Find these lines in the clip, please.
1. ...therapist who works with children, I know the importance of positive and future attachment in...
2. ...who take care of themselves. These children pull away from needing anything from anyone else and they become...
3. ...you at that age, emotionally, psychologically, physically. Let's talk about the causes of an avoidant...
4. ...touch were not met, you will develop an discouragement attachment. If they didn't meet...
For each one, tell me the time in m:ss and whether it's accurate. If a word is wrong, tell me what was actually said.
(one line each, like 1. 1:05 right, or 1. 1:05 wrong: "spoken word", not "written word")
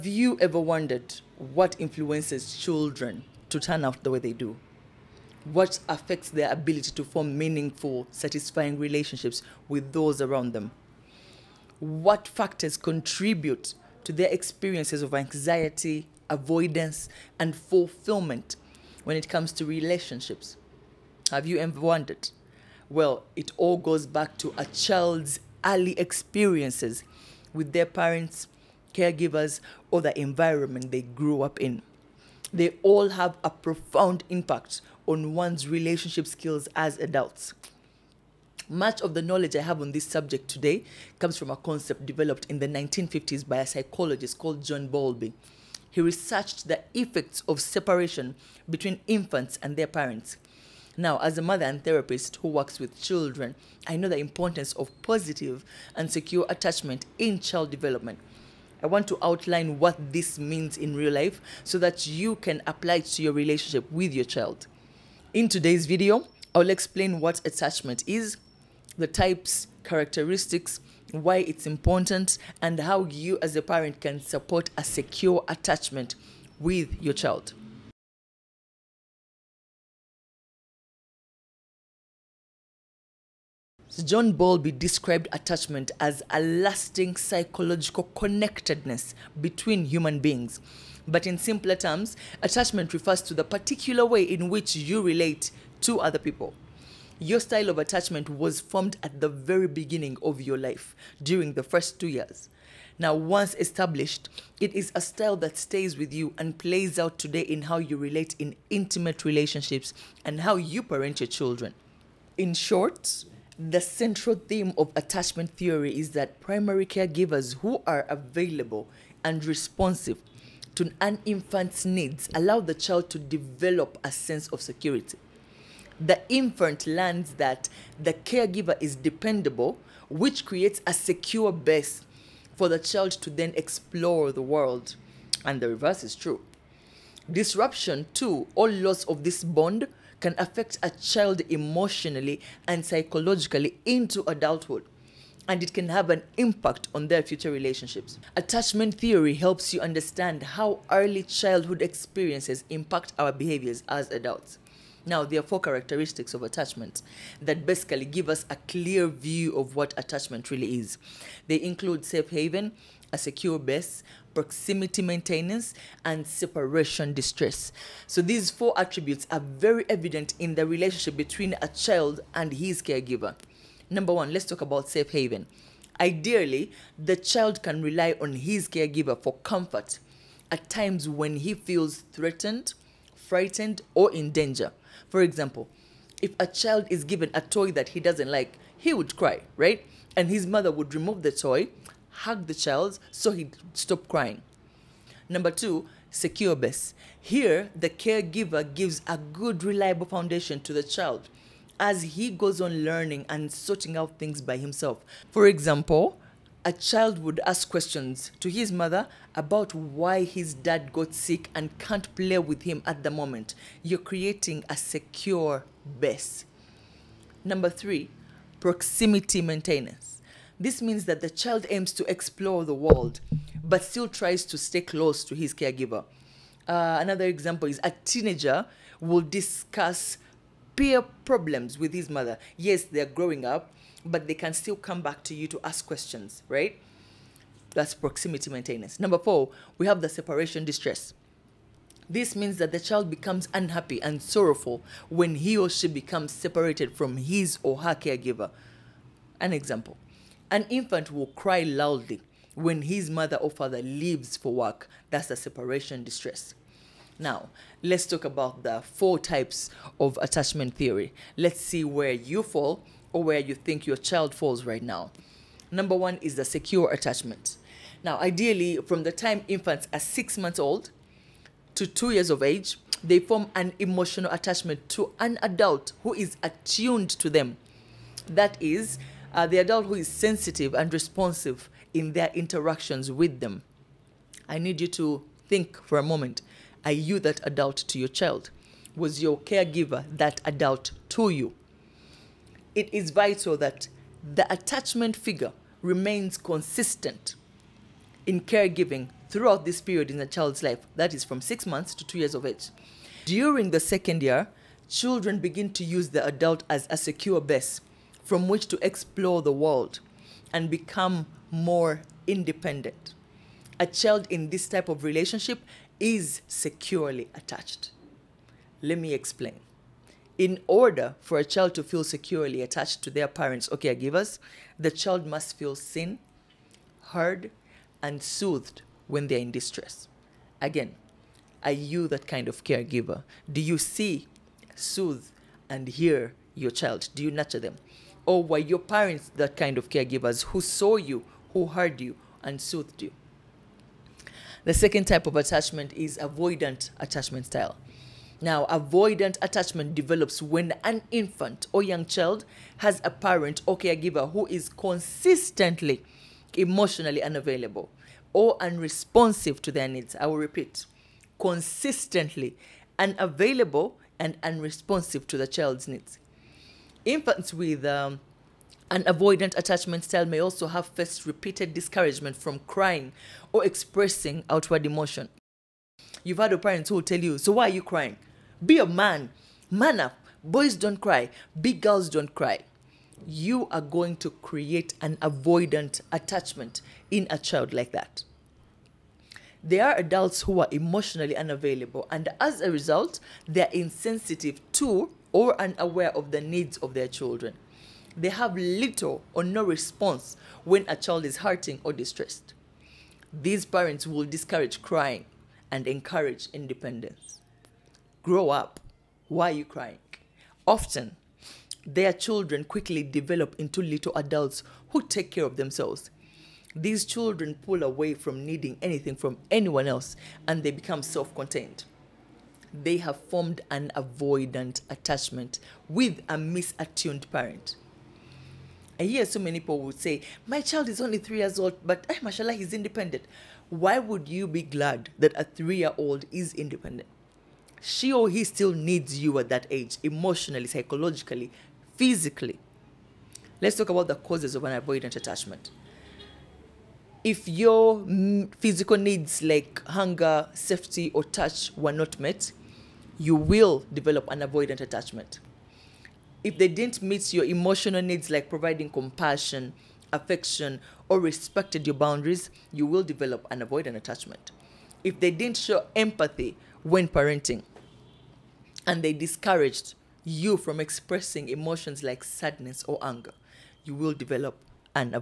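1. 0:51 wrong: "secure", not "future"
2. 6:54 right
3. 7:19 right
4. 7:31 wrong: "avoidant", not "discouragement".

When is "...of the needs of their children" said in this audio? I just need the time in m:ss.
6:36.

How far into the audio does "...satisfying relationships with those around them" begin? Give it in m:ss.
0:08.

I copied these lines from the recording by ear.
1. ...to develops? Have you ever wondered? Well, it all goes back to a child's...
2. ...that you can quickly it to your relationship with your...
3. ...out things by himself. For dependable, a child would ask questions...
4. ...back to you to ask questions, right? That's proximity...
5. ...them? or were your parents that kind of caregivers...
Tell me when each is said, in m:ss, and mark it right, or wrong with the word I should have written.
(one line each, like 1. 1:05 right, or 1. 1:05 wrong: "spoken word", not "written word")
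1. 0:19 wrong: "relationships", not "develops"
2. 1:01 wrong: "apply", not "quickly"
3. 3:23 wrong: "example", not "dependable"
4. 3:55 right
5. 5:37 right.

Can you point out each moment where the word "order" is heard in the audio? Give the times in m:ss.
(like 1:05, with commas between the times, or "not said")
5:20.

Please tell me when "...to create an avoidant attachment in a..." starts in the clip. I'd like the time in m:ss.
6:24.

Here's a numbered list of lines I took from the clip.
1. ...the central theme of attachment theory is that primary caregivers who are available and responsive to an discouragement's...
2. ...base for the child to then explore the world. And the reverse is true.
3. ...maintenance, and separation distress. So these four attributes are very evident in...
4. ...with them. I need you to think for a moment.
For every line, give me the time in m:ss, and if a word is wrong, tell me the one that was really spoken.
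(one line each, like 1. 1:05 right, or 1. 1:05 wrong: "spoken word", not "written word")
1. 1:53 wrong: "infant", not "discouragement"
2. 2:11 right
3. 2:45 right
4. 4:43 right.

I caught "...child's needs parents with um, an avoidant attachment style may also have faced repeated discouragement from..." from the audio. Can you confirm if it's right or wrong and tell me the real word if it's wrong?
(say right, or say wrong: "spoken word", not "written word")
wrong: "infants", not "parents".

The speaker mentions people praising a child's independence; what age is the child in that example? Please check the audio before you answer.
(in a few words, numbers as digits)
3.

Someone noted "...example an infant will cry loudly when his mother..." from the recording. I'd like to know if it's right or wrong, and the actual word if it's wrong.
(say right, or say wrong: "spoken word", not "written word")
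right.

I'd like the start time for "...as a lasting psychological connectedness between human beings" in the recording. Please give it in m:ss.
1:25.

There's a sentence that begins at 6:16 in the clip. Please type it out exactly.
You've had parents who will tell you, So why are you crying?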